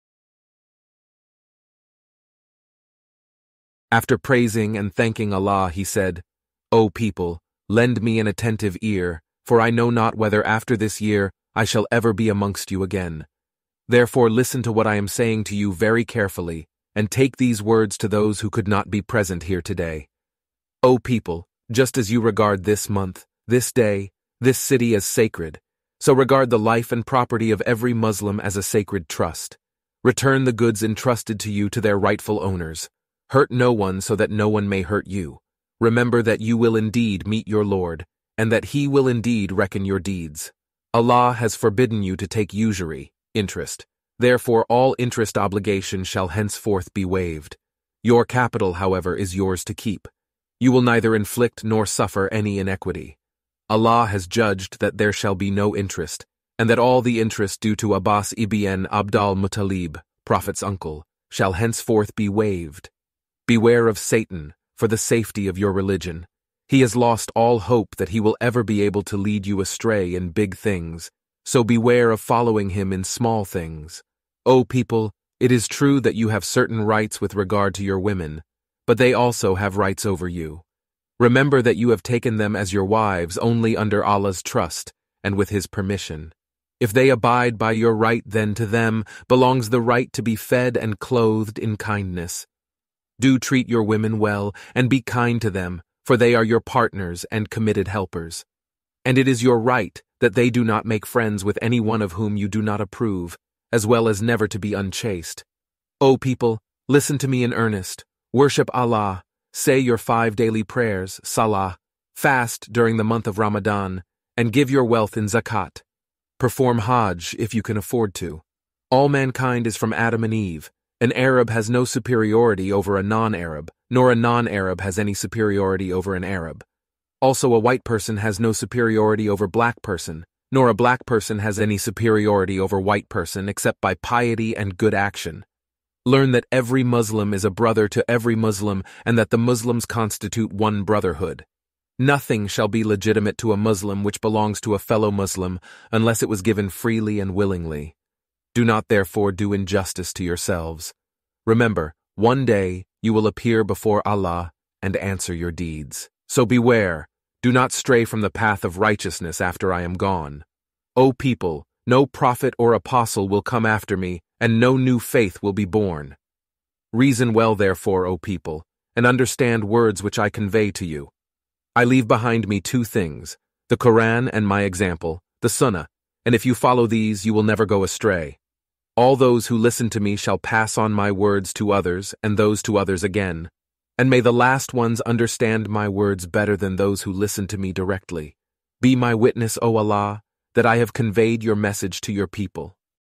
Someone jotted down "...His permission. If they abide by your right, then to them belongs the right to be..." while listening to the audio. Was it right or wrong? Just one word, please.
right.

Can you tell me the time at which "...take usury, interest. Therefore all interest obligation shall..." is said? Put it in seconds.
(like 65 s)
42 s.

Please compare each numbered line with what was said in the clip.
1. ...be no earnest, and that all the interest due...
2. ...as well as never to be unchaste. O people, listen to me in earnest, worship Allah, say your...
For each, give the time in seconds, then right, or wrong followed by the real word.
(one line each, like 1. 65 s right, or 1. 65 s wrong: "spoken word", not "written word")
1. 55 s wrong: "interest", not "earnest"
2. 103 s right.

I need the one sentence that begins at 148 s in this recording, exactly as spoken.
Do not therefore do injustice to yourselves.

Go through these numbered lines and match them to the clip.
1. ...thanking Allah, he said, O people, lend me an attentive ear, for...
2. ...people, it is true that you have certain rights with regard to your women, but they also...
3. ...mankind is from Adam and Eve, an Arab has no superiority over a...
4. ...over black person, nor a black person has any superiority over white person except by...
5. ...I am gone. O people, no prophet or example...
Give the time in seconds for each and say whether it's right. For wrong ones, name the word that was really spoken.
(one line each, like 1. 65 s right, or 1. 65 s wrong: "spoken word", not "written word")
1. 4 s right
2. 74 s right
3. 119 s right
4. 129 s right
5. 159 s wrong: "apostle", not "example".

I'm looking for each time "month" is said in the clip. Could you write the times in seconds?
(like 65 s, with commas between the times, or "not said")
22 s, 113 s.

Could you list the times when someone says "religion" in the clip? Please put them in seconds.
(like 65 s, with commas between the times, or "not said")
65 s.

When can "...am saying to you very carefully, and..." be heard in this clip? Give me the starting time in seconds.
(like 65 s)
14 s.